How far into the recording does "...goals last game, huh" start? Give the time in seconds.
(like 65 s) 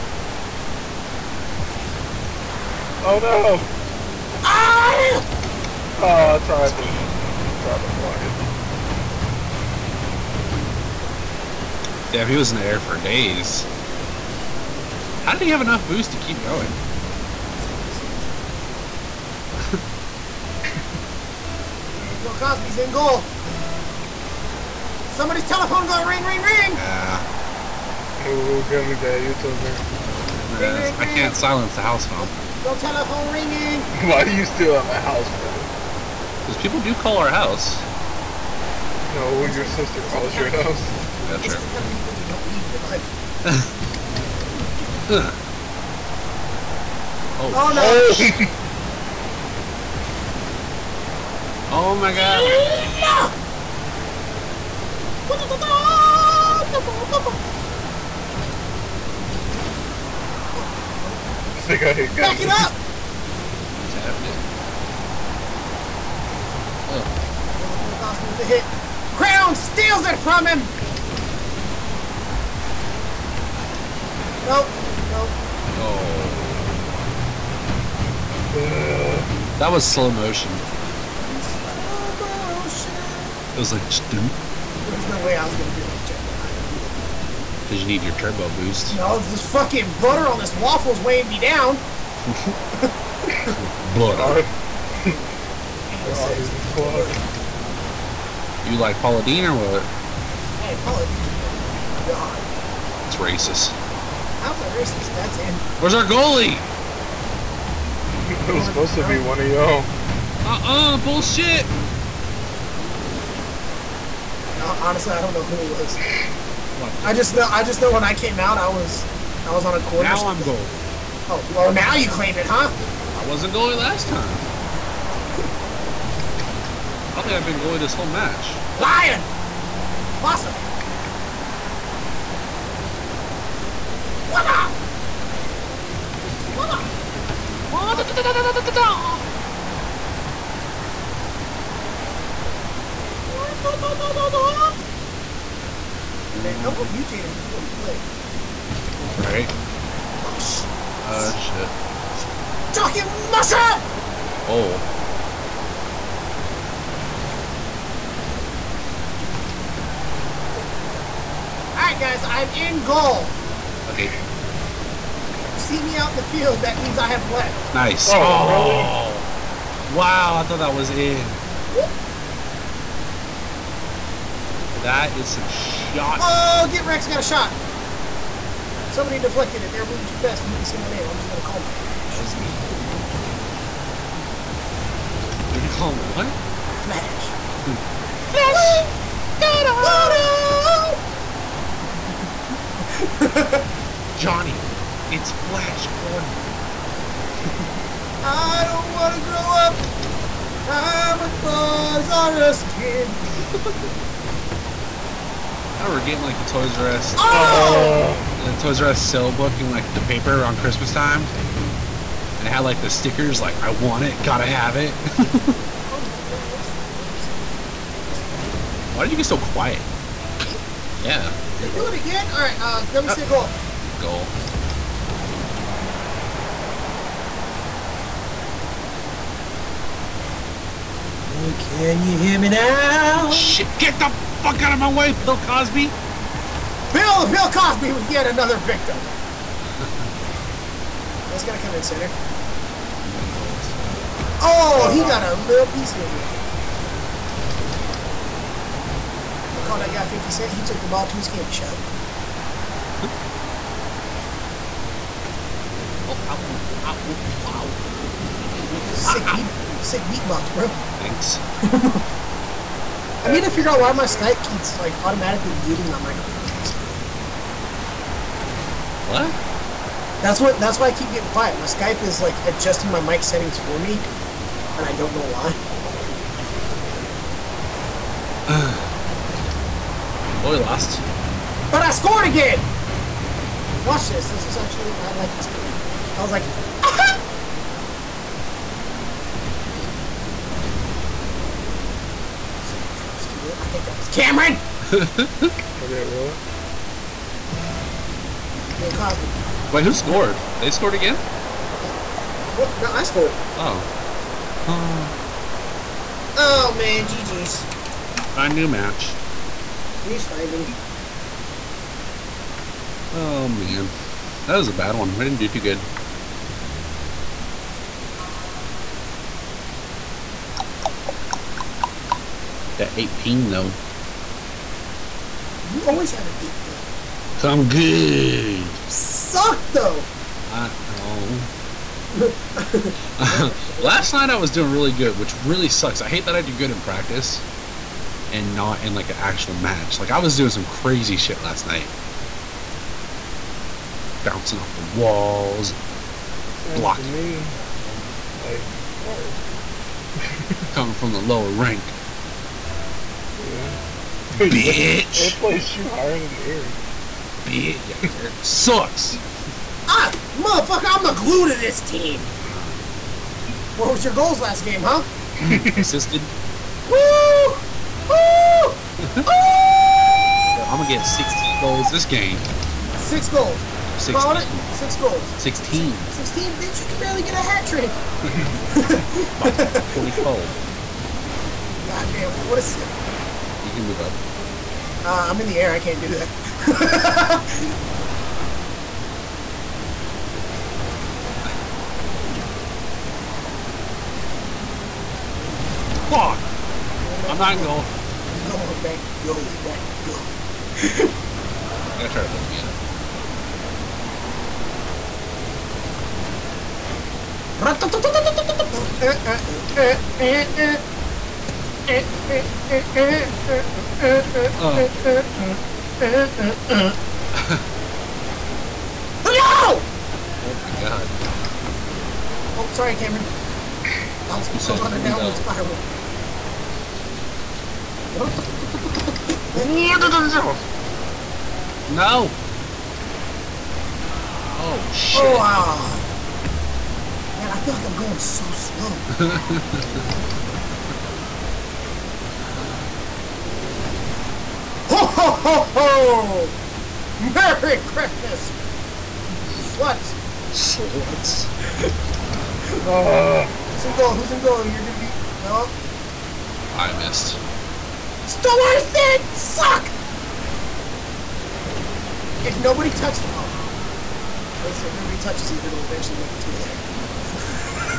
364 s.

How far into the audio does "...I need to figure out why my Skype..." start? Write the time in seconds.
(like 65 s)
263 s.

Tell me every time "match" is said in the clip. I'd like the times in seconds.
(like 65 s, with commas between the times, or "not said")
128 s, 308 s, 339 s.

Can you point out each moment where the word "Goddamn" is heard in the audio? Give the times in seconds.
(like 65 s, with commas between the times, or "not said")
381 s.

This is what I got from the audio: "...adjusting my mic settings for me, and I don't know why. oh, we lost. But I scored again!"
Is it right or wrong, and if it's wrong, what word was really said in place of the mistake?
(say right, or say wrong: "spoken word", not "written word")
right.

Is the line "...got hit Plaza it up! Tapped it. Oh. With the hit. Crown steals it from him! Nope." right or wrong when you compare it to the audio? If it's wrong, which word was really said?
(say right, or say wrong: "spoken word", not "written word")
wrong: "Back", not "Plaza".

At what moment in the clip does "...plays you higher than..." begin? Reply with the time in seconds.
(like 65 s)
355 s.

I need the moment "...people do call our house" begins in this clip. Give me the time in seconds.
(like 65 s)
36 s.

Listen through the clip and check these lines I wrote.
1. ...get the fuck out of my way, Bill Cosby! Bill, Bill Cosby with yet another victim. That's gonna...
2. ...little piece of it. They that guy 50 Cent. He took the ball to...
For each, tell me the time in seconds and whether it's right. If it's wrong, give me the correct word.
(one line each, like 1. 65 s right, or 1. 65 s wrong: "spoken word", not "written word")
1. 233 s right
2. 245 s right.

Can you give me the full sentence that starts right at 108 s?
It was supposed to be one of y'all.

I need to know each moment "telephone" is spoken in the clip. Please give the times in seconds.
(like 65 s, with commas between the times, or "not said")
25 s, 32 s.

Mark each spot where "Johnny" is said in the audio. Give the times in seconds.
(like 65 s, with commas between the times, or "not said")
194 s.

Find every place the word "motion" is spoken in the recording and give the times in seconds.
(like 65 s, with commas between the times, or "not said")
80 s.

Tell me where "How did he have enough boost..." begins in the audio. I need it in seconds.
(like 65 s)
15 s.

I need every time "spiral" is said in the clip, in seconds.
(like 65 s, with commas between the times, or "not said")
425 s.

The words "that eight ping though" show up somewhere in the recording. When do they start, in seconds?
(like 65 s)
322 s.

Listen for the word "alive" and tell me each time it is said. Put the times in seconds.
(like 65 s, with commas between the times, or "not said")
86 s.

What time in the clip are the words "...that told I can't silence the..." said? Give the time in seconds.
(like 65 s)
29 s.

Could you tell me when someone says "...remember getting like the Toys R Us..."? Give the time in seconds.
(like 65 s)
205 s.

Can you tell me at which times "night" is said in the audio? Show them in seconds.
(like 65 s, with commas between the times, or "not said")
334 s, 341 s.